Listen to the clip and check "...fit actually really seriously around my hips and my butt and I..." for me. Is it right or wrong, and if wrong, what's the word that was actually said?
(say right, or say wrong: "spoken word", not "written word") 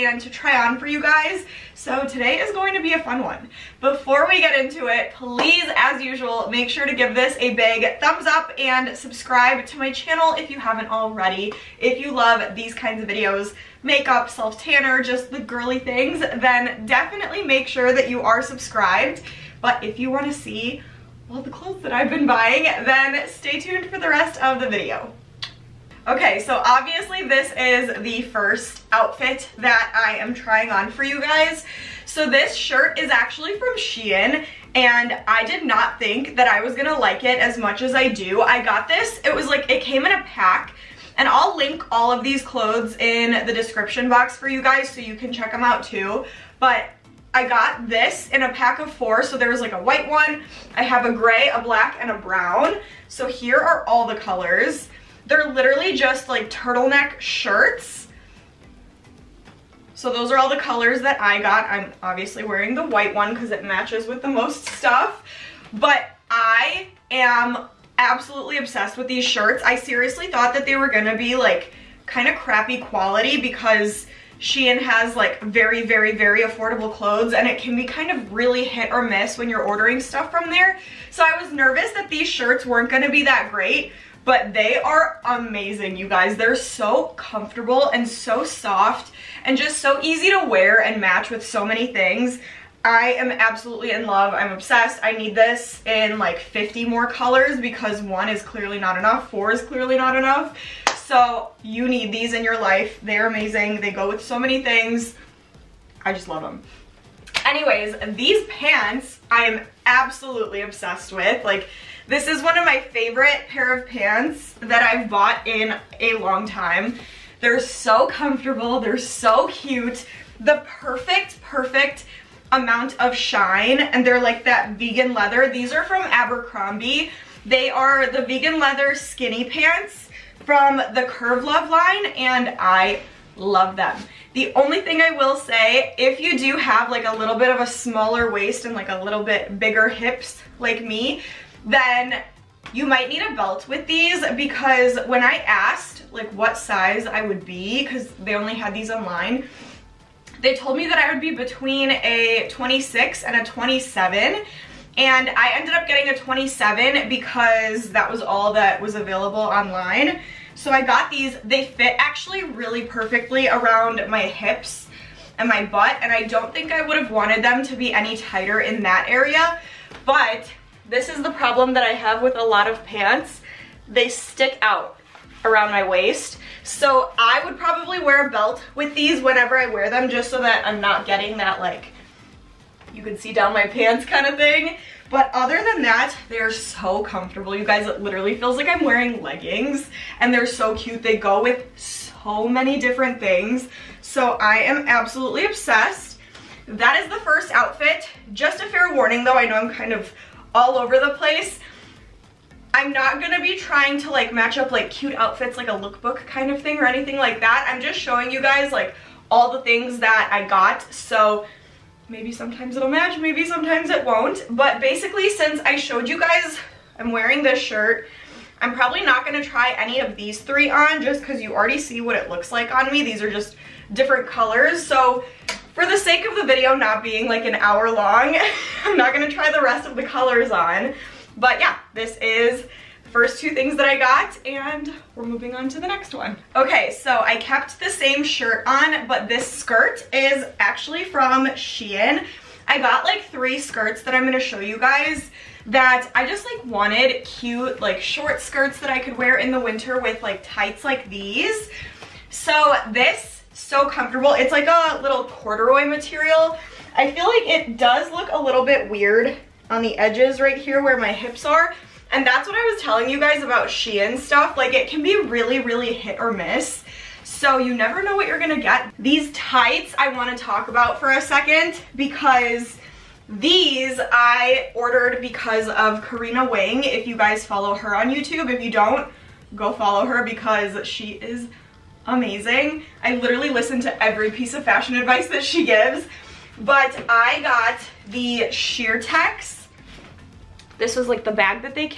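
wrong: "perfectly", not "seriously".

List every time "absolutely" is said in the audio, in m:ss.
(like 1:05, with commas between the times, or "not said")
1:07, 1:33, 1:49, 3:14.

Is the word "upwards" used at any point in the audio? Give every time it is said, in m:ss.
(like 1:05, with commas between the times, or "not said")
not said.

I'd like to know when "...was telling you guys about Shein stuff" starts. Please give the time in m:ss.
4:22.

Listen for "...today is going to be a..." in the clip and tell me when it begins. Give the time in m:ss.
0:02.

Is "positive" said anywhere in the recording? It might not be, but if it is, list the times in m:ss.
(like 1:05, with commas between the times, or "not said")
not said.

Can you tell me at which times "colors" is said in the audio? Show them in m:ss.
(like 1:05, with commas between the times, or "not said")
0:54, 1:00, 1:37, 3:44, 3:50.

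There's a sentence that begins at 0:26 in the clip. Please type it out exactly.
Okay, so obviously this is the first outfit that I am trying on for you guys.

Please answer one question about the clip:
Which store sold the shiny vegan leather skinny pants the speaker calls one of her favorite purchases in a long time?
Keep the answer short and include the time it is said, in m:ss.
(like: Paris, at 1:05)
Abercrombie, at 2:06.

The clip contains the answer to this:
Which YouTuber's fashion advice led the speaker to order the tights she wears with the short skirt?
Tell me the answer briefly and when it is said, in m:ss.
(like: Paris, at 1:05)
Karina Wing, at 4:36.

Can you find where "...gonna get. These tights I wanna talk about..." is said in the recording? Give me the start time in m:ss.
4:28.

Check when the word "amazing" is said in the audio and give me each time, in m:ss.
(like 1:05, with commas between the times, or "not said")
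1:25, 1:43, 4:42.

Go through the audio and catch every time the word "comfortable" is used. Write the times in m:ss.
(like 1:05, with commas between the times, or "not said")
1:27, 1:58, 3:07, 4:13.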